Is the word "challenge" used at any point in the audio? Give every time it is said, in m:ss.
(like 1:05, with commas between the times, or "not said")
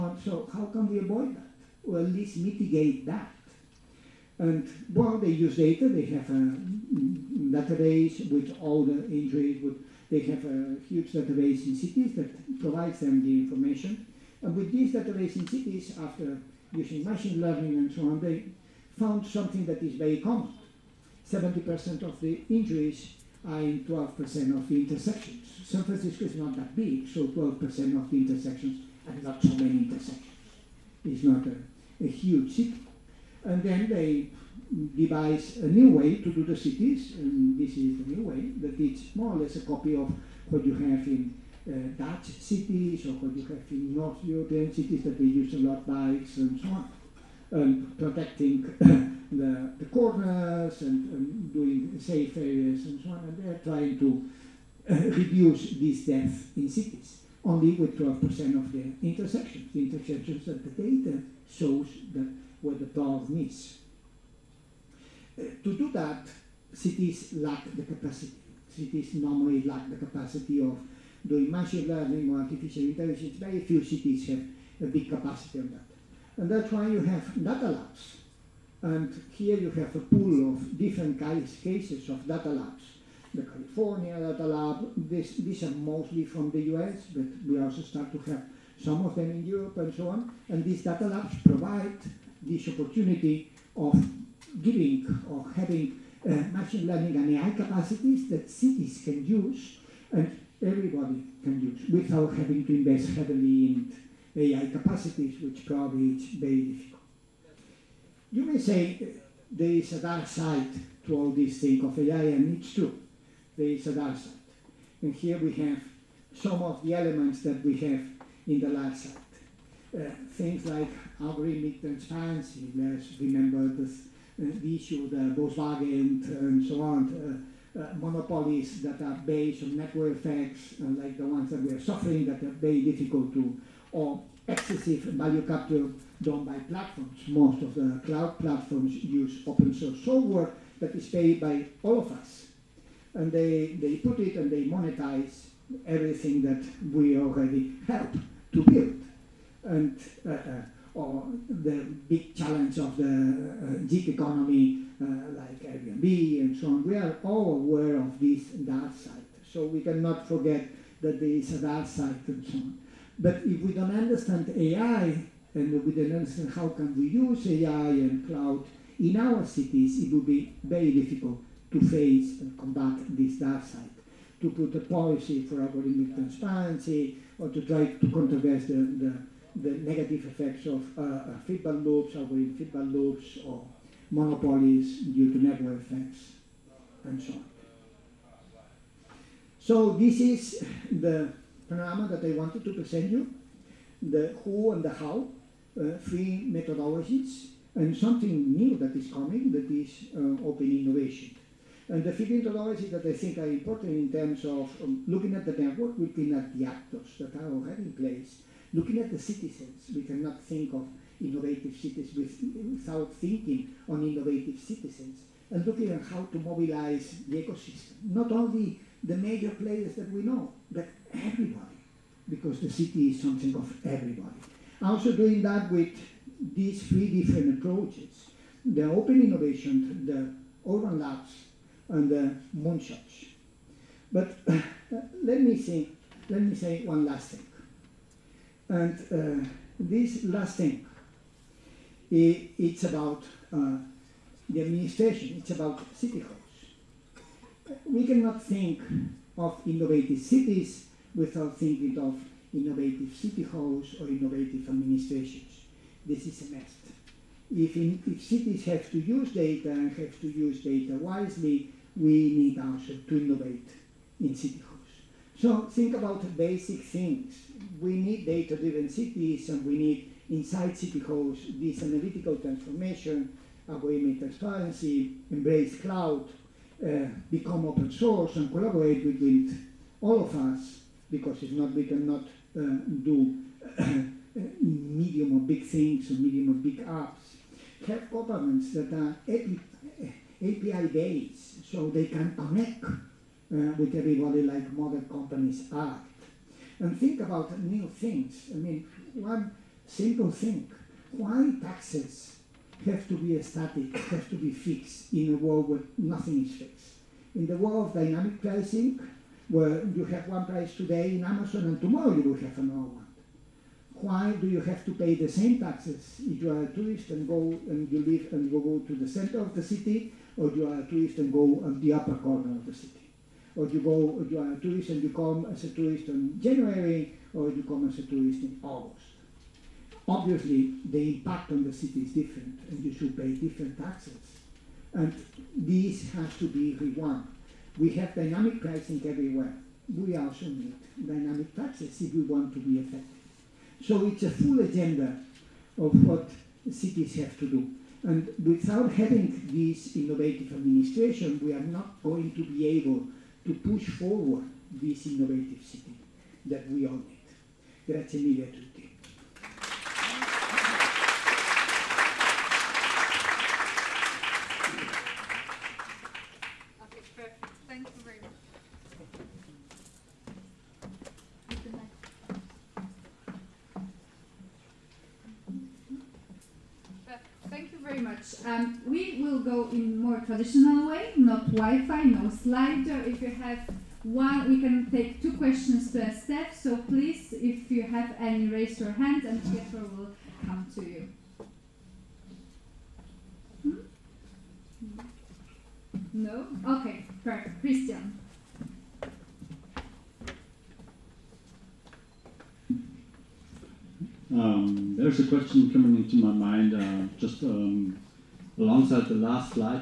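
2:32.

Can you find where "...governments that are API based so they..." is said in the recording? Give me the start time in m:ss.
4:48.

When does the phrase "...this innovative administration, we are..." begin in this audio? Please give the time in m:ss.
5:49.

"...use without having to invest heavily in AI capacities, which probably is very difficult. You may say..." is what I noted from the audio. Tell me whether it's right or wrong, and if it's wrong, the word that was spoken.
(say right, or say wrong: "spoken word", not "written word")
right.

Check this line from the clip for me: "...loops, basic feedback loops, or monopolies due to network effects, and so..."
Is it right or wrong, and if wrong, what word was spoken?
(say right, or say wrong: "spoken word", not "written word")
wrong: "algorithmic", not "basic".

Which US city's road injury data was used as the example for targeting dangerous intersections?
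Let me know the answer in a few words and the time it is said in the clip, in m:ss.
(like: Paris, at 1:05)
San Francisco, at 0:25.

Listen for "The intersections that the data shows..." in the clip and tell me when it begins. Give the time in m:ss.
0:59.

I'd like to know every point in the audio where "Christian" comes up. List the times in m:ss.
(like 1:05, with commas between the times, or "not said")
6:37.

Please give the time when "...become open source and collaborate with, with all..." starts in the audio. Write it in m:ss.
4:37.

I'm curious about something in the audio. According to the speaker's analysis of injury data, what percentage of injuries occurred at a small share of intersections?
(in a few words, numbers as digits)
70%.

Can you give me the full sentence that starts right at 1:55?
And here we have some of the elements that we have in the dark side.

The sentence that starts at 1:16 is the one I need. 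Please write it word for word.
And that's why you have data labs.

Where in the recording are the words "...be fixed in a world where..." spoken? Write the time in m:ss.
5:04.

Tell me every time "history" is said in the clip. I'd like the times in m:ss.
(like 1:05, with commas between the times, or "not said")
not said.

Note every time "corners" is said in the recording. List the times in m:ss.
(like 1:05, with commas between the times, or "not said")
0:49, 5:22.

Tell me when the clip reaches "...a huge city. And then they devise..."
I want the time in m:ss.
0:32.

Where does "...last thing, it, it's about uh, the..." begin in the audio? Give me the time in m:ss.
4:00.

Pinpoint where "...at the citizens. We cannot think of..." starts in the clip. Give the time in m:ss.
3:28.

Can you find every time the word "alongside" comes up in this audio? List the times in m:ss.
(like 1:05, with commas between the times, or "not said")
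6:48.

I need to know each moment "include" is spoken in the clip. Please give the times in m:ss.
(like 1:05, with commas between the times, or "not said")
not said.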